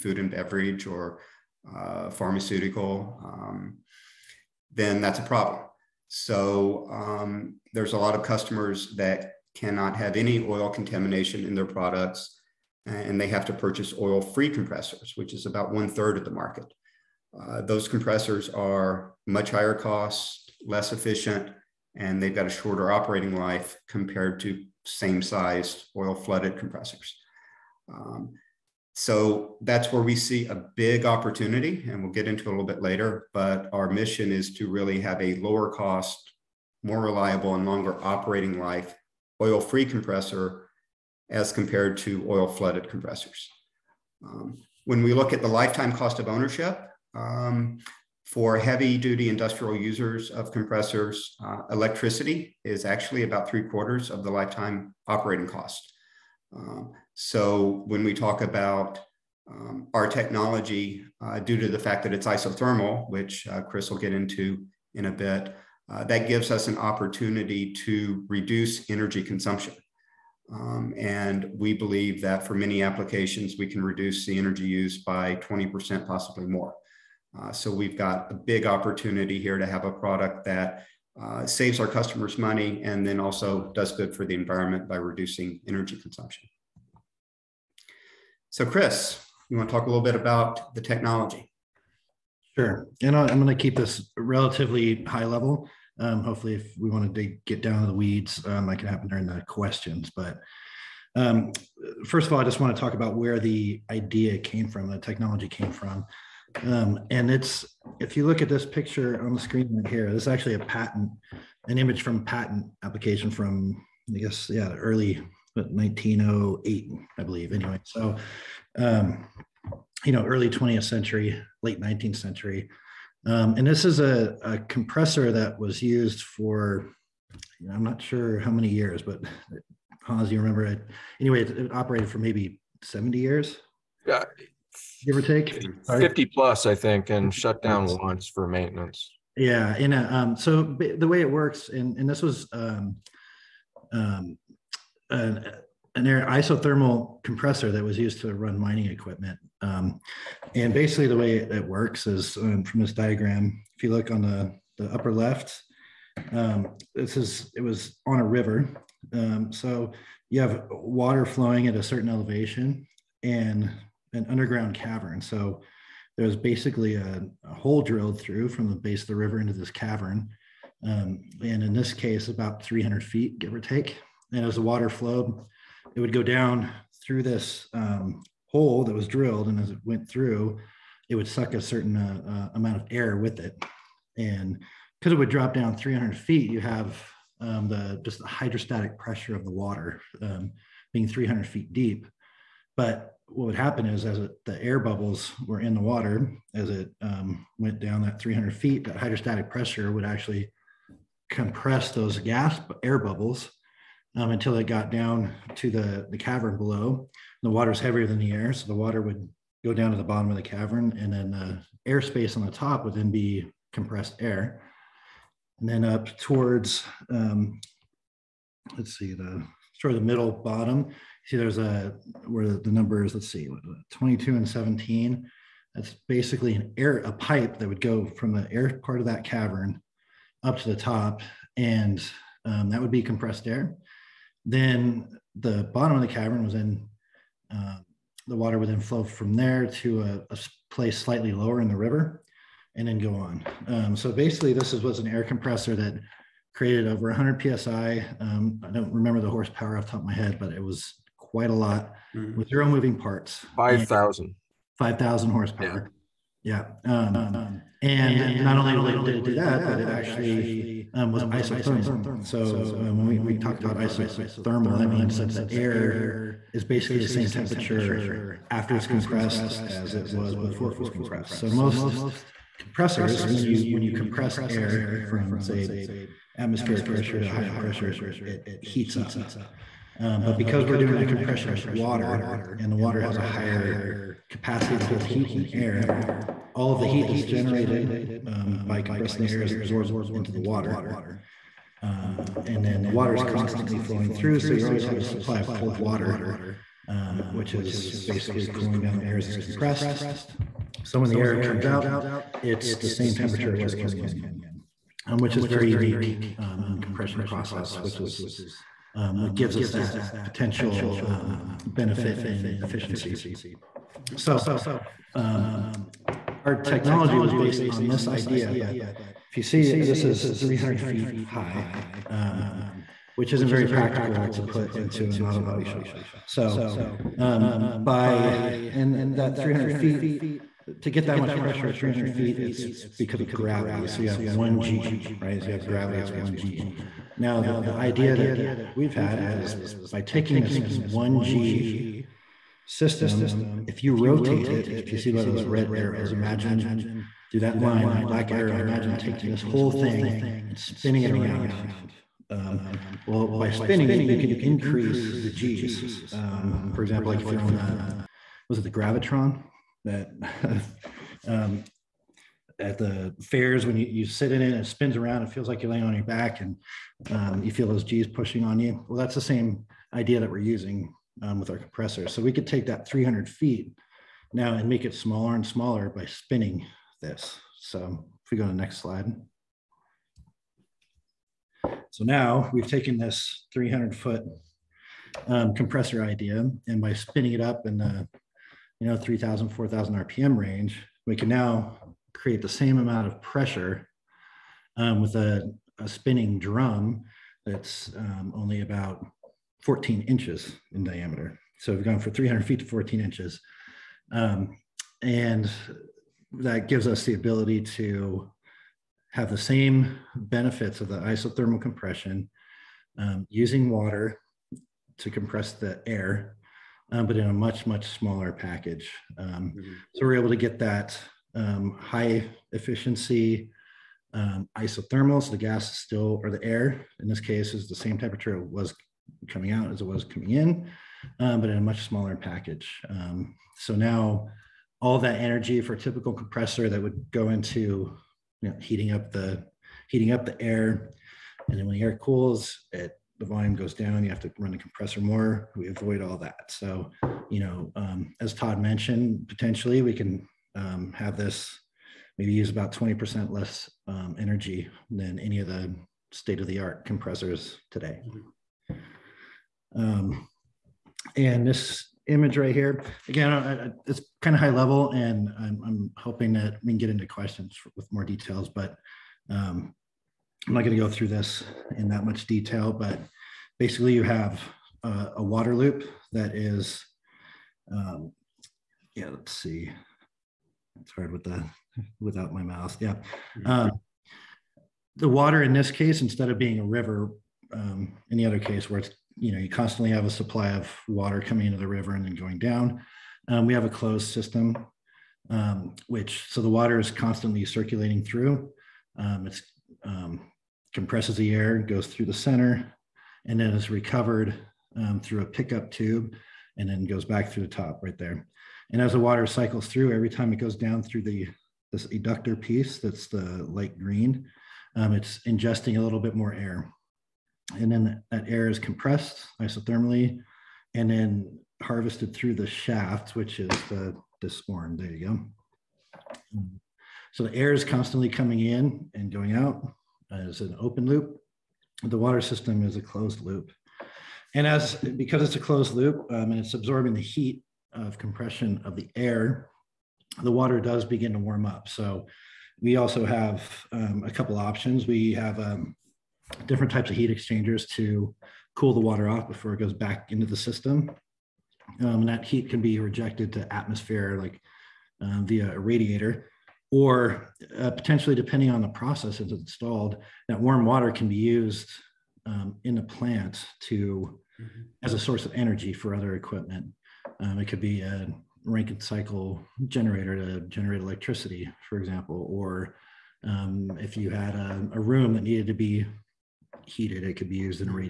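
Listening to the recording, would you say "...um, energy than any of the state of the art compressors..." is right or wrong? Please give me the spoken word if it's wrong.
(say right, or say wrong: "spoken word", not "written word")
right.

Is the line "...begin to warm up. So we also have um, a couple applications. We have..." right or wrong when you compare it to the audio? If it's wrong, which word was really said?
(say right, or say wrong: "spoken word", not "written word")
wrong: "options", not "applications".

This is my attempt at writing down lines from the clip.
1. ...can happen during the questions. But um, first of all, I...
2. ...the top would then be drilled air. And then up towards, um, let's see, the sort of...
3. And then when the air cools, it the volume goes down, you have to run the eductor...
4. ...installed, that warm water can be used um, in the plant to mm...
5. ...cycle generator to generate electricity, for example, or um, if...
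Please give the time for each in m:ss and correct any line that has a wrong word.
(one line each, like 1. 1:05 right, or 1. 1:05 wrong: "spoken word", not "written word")
1. 1:38 right
2. 3:32 wrong: "compressed", not "drilled"
3. 7:21 wrong: "compressor", not "eductor"
4. 9:19 right
5. 9:28 right.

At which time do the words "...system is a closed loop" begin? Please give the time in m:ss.
8:52.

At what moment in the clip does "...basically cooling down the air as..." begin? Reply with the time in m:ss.
4:58.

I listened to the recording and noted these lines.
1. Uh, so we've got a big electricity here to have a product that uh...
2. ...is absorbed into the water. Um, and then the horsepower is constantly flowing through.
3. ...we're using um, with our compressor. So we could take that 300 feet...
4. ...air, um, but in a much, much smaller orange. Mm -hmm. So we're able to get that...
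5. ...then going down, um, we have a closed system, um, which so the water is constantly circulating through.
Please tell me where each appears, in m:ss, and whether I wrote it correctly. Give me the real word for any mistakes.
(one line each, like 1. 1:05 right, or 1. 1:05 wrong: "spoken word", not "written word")
1. 1:17 wrong: "opportunity", not "electricity"
2. 4:49 wrong: "water", not "horsepower"
3. 6:10 right
4. 6:55 wrong: "package", not "orange"
5. 8:12 right.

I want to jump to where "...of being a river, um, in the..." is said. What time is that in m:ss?
8:06.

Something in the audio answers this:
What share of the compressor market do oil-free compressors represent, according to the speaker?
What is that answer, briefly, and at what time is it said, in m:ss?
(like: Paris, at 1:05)
one third, at 0:15.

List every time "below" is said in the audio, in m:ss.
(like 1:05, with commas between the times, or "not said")
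3:26.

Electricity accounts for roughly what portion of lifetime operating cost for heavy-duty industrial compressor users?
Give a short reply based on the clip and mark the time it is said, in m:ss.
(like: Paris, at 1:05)
three quarters, at 0:53.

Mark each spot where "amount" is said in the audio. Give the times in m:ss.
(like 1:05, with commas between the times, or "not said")
3:02, 6:32.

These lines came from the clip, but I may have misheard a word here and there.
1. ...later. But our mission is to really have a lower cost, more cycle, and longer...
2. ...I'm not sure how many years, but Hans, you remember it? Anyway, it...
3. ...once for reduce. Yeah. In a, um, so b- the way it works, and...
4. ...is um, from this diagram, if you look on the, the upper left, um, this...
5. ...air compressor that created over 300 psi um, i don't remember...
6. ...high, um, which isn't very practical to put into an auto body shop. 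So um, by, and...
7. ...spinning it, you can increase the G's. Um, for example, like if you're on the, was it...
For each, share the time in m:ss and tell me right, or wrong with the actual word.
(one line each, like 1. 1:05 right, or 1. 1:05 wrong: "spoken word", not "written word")
1. 0:32 wrong: "reliable", not "cycle"
2. 2:07 right
3. 2:17 wrong: "maintenance", not "reduce"
4. 2:32 right
5. 4:05 wrong: "100", not "300"
6. 5:21 right
7. 5:53 right.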